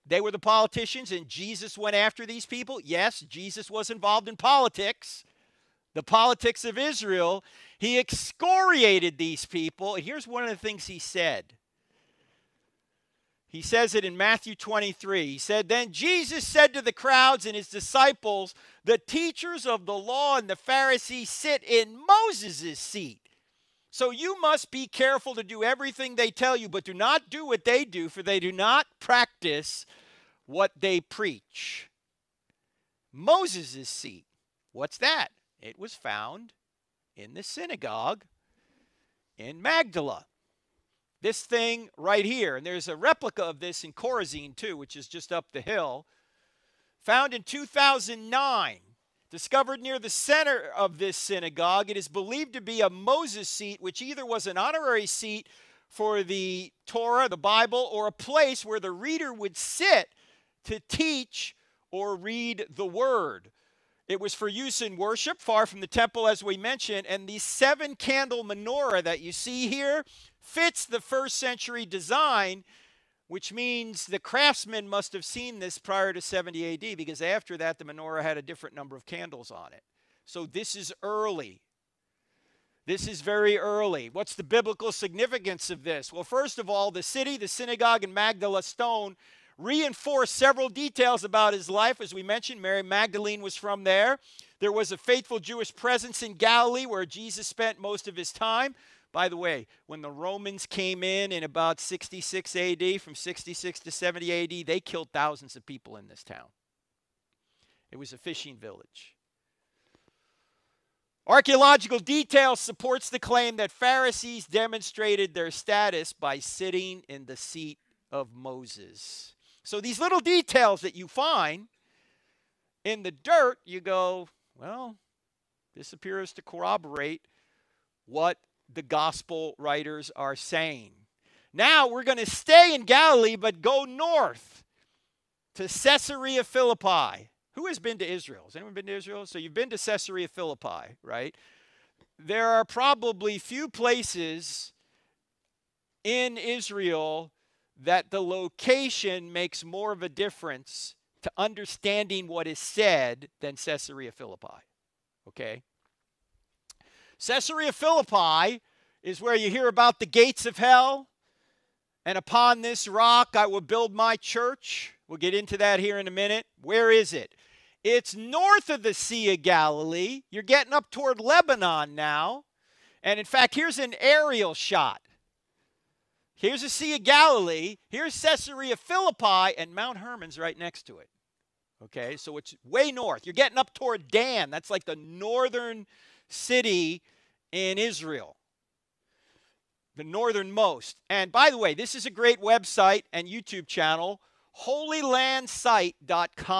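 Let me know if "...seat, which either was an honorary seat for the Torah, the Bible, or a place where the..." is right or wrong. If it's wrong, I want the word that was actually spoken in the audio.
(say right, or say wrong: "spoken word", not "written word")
right.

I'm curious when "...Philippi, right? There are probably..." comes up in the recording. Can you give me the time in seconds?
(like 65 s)
140 s.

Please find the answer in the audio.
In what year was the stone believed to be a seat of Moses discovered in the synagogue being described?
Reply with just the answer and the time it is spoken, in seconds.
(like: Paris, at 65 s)
2009, at 47 s.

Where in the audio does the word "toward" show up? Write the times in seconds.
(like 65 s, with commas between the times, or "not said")
170 s, 183 s.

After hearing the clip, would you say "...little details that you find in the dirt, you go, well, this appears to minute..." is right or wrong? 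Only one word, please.
wrong.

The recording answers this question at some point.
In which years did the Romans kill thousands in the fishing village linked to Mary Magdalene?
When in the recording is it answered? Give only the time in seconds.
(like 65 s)
103 s.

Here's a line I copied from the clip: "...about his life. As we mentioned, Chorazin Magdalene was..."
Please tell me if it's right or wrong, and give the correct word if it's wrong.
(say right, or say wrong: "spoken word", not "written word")
wrong: "Mary", not "Chorazin".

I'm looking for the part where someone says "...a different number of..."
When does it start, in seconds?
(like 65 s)
78 s.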